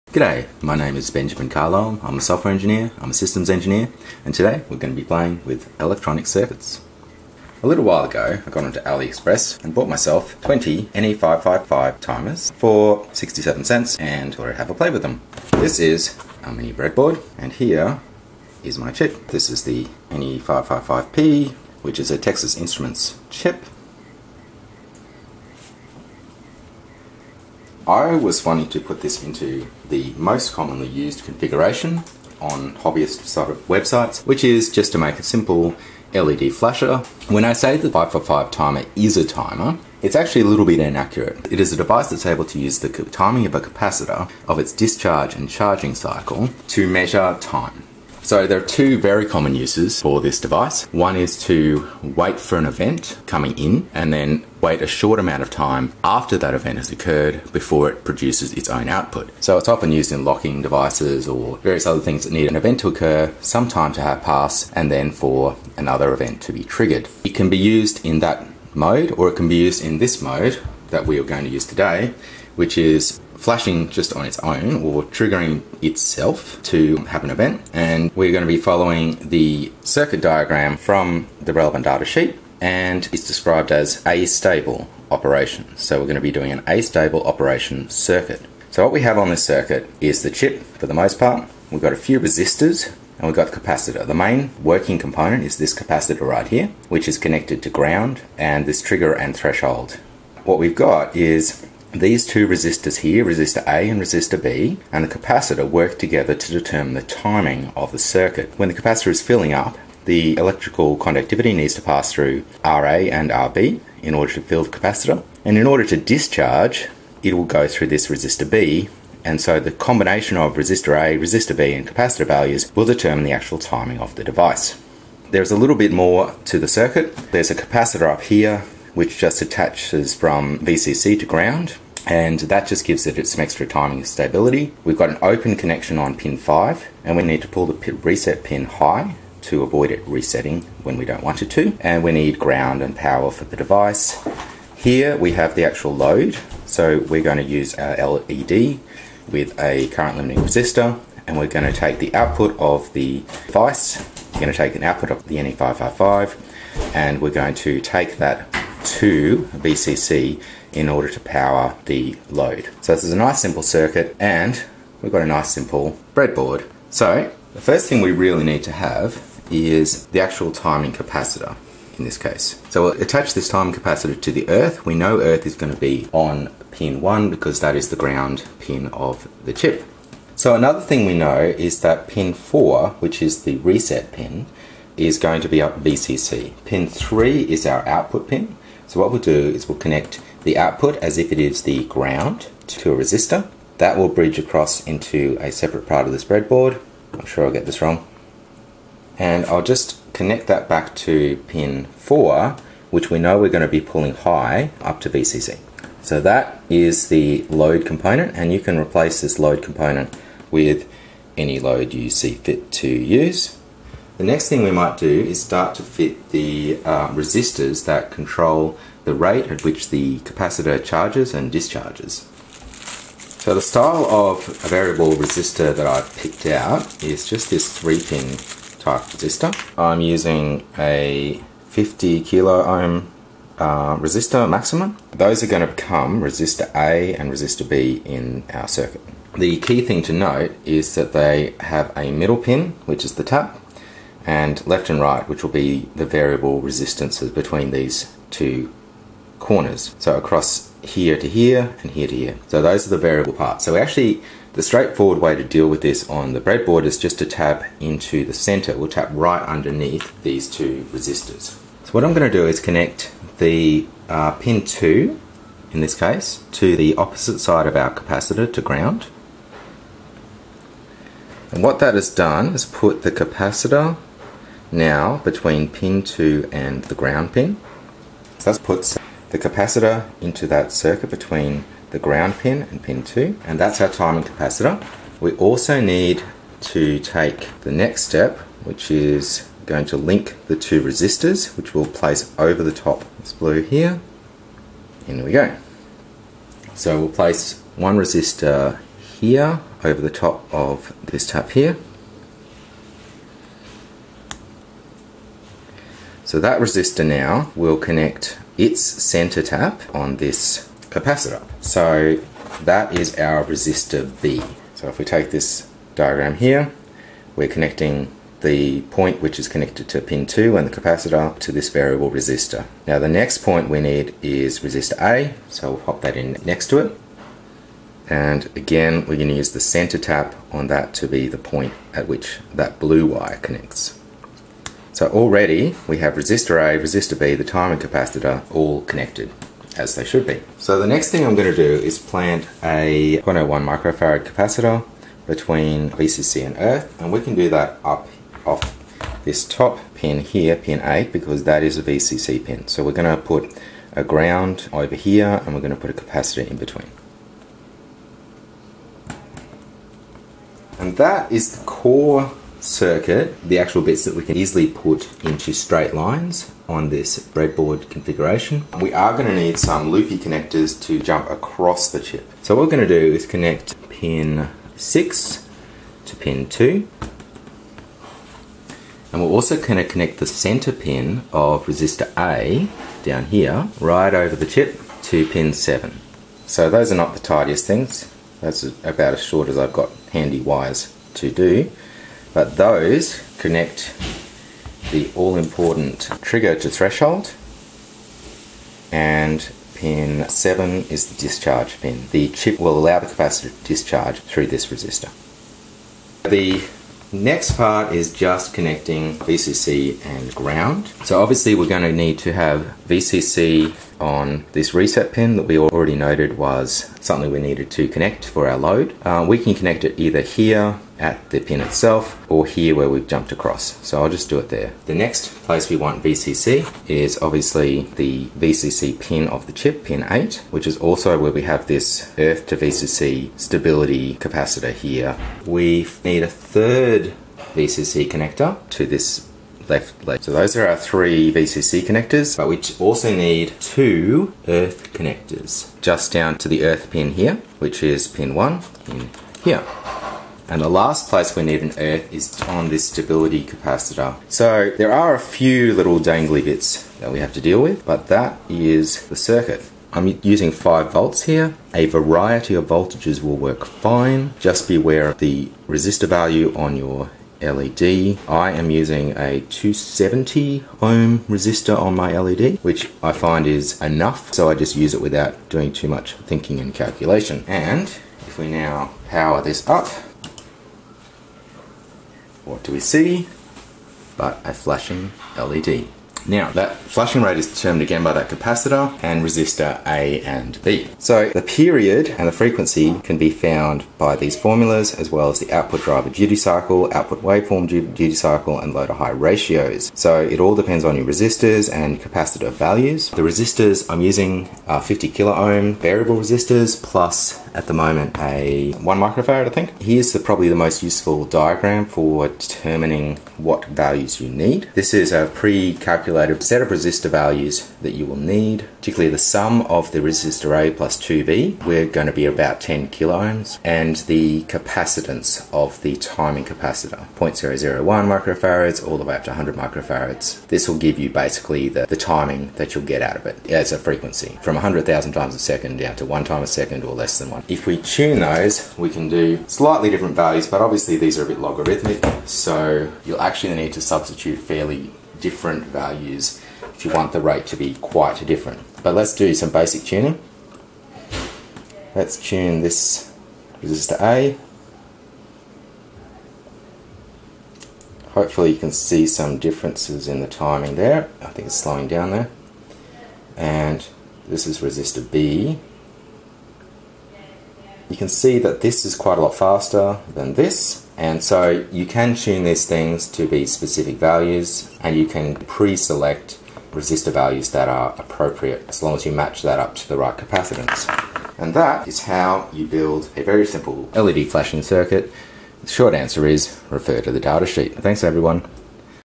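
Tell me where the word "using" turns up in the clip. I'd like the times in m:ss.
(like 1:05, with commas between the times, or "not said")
3:50, 7:40, 7:48, 8:24.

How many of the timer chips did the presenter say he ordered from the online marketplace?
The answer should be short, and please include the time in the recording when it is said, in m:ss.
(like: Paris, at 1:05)
20, at 0:10.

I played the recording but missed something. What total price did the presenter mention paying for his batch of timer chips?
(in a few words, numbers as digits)
67 cents.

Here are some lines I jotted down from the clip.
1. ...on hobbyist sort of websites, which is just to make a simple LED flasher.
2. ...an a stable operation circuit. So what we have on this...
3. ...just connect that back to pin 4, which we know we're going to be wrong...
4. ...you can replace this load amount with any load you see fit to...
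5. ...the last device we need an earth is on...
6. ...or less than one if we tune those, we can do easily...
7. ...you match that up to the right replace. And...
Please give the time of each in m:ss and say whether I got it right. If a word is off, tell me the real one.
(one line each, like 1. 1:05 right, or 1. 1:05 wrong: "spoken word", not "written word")
1. 0:32 right
2. 1:26 right
3. 3:19 wrong: "pulling", not "wrong"
4. 3:28 wrong: "component", not "amount"
5. 7:30 wrong: "place", not "device"
6. 8:56 wrong: "slightly", not "easily"
7. 9:39 wrong: "capacitance", not "replace".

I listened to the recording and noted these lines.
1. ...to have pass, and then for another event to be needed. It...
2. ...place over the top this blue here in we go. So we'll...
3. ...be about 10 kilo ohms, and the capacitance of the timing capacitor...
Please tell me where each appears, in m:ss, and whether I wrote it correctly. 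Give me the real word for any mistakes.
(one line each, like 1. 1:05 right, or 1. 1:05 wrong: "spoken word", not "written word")
1. 1:03 wrong: "triggered", not "needed"
2. 4:51 right
3. 8:42 right.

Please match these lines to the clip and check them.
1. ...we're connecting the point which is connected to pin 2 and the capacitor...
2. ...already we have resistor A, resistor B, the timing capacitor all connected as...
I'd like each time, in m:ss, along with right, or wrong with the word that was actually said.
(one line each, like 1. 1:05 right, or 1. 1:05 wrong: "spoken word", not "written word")
1. 5:17 right
2. 5:35 right.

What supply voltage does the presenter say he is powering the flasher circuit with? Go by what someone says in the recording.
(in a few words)
5 volts.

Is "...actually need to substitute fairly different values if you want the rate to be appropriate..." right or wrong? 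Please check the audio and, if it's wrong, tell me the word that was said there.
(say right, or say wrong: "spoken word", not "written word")
wrong: "quite", not "appropriate".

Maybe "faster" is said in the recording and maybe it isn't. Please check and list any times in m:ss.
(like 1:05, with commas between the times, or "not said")
9:29.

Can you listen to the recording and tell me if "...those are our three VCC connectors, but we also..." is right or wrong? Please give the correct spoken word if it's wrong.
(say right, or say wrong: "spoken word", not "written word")
right.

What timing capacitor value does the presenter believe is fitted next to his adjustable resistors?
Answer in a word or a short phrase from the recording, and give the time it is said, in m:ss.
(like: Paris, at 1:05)
1 microfarad, at 8:28.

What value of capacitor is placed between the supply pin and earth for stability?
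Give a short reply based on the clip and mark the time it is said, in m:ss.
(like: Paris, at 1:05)
0.01 microfarad, at 5:43.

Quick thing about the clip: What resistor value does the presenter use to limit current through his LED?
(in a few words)
270 ohm.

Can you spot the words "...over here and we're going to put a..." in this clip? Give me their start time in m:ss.
5:54.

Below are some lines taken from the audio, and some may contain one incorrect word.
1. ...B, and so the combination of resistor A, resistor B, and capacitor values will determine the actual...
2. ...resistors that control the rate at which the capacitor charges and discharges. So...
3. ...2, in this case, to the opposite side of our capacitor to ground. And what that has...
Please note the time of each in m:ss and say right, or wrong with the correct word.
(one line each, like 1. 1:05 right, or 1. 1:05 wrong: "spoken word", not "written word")
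1. 1:58 right
2. 3:37 right
3. 4:24 right.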